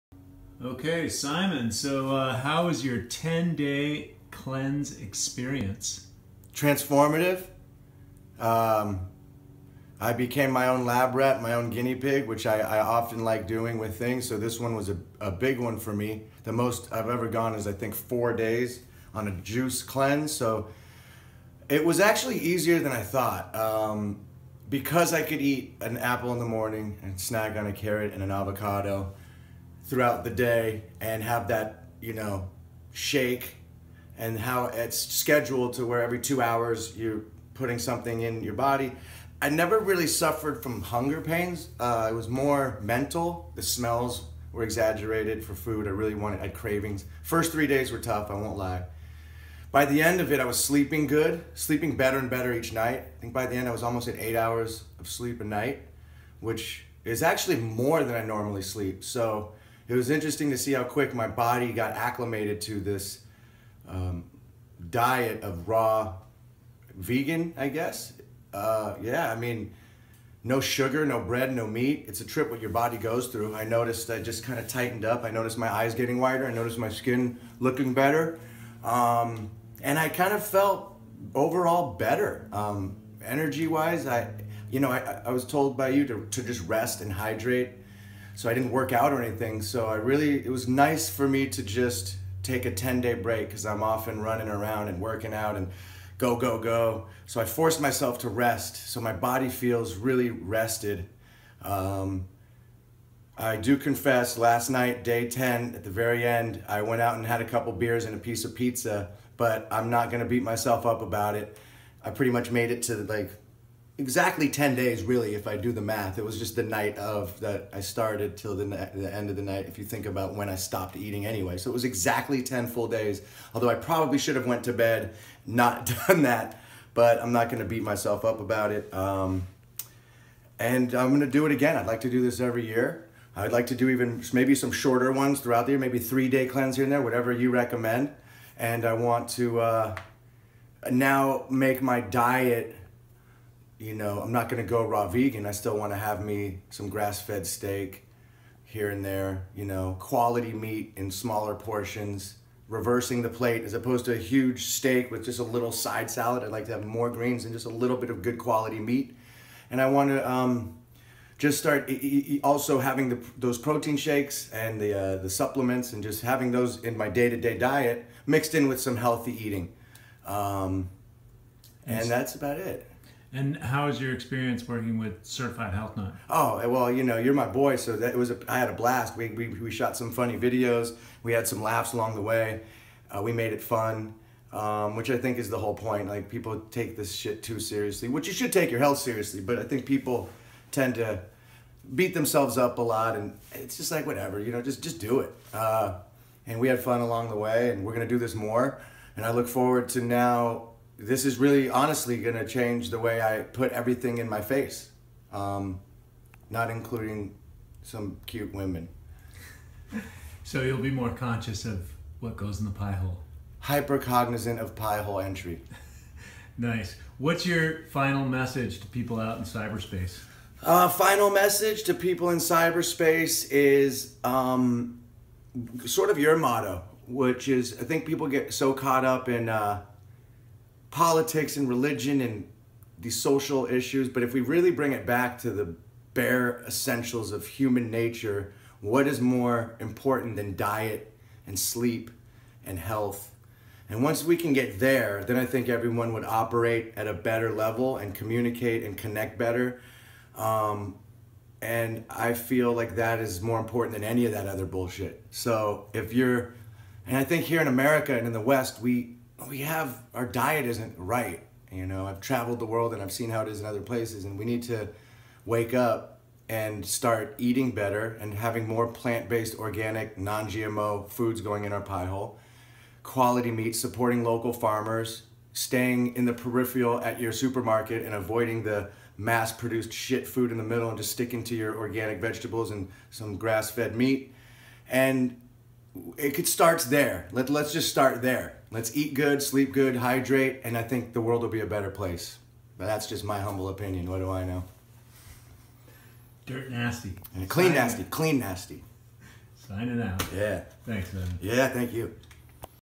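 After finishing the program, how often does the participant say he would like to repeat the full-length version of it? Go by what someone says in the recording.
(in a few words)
Every year.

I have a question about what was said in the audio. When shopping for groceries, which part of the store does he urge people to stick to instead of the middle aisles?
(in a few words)
The peripheral.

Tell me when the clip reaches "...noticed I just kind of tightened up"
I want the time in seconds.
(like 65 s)
73 s.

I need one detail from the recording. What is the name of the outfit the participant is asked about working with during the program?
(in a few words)
Certified Health Nut.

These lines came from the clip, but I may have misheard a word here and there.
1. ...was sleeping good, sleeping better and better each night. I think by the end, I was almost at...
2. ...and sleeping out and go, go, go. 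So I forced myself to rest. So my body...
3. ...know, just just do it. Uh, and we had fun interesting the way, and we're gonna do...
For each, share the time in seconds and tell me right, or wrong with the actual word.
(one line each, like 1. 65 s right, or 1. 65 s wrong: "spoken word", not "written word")
1. 50 s right
2. 94 s wrong: "working", not "sleeping"
3. 194 s wrong: "along", not "interesting".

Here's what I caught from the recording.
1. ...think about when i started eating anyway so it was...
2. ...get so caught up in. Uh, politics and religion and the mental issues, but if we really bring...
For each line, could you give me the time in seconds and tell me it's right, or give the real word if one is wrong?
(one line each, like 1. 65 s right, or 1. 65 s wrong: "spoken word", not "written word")
1. 119 s wrong: "stopped", not "started"
2. 228 s wrong: "social", not "mental".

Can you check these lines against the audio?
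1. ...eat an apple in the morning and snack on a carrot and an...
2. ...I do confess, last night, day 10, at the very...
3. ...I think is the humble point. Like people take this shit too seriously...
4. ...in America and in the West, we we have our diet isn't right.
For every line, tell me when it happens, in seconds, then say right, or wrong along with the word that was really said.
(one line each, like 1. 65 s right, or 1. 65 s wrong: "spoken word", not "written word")
1. 25 s right
2. 103 s right
3. 185 s wrong: "whole", not "humble"
4. 257 s right.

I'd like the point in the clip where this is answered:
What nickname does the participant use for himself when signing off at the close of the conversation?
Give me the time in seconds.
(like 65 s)
296 s.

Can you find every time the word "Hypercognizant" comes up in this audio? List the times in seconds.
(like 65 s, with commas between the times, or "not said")
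213 s.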